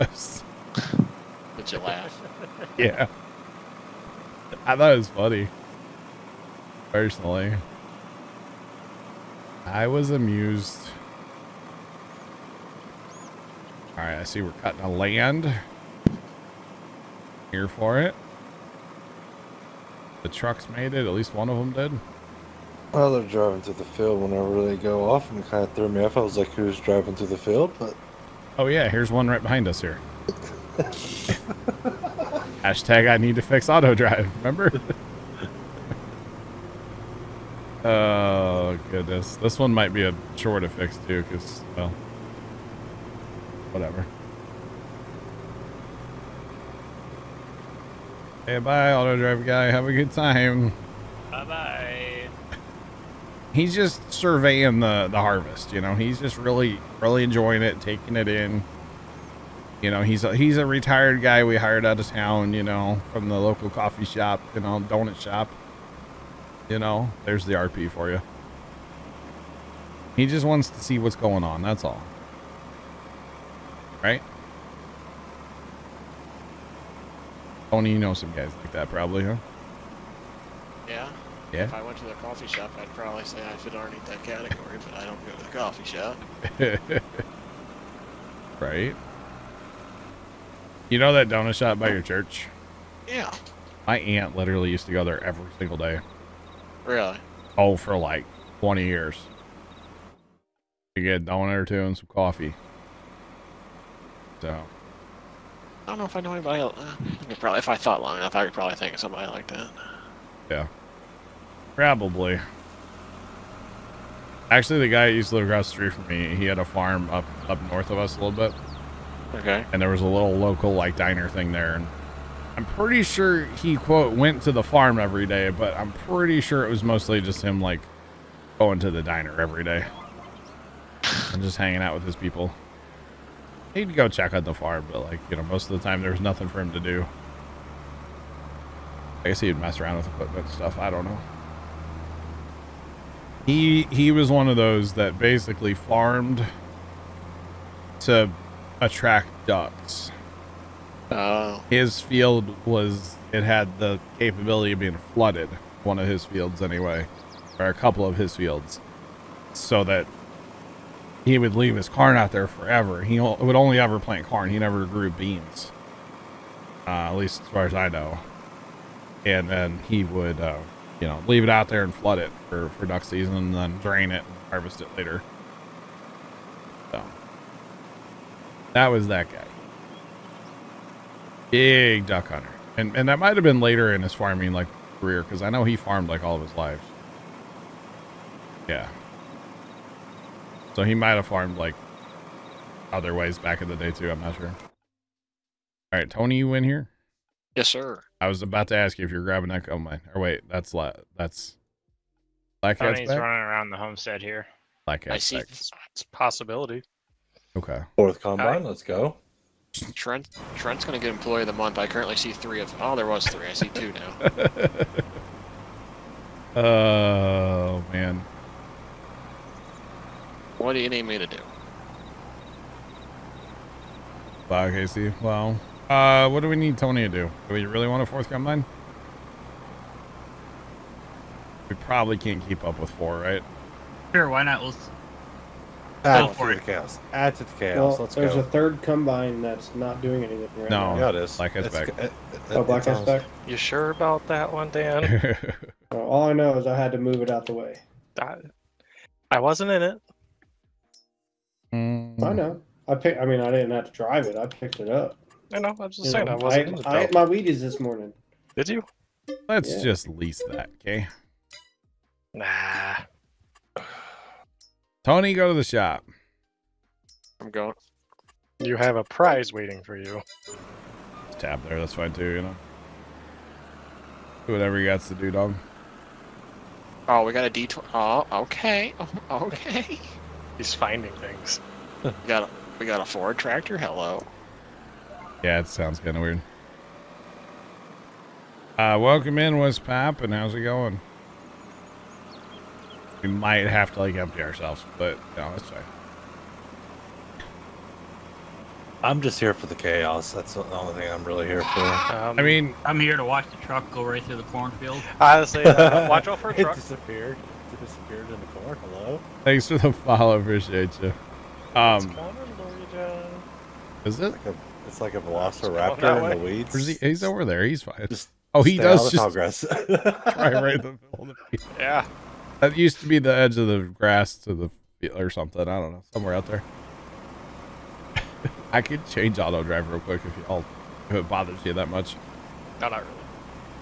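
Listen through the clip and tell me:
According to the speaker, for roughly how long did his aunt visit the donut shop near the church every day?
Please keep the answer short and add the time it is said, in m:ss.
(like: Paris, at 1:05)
20 years, at 1:38.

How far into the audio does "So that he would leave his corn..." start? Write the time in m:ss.
2:39.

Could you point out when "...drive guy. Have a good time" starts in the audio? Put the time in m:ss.
0:49.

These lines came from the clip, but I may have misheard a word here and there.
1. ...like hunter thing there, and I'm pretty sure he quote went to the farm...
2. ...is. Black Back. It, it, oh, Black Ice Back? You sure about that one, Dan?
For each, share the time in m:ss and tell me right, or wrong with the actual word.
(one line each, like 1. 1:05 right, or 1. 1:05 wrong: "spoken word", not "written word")
1. 2:00 wrong: "diner", not "hunter"
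2. 4:01 right.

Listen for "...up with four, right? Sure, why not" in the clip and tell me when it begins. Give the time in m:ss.
3:52.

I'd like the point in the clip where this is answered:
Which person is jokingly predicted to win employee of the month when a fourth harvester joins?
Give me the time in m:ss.
3:30.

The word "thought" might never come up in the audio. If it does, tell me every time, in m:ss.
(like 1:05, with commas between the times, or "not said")
0:04, 1:47.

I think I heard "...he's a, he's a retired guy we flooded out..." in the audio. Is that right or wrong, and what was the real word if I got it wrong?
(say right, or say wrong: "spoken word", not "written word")
wrong: "hired", not "flooded".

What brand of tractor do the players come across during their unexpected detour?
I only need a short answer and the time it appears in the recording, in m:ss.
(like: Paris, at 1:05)
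Ford, at 4:43.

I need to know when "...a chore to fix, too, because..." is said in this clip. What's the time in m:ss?
0:40.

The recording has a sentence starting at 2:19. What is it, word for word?
I guess he'd mess around with equipment stuff.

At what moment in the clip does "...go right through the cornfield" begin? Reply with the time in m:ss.
5:03.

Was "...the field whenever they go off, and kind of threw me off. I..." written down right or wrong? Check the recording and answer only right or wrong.
right.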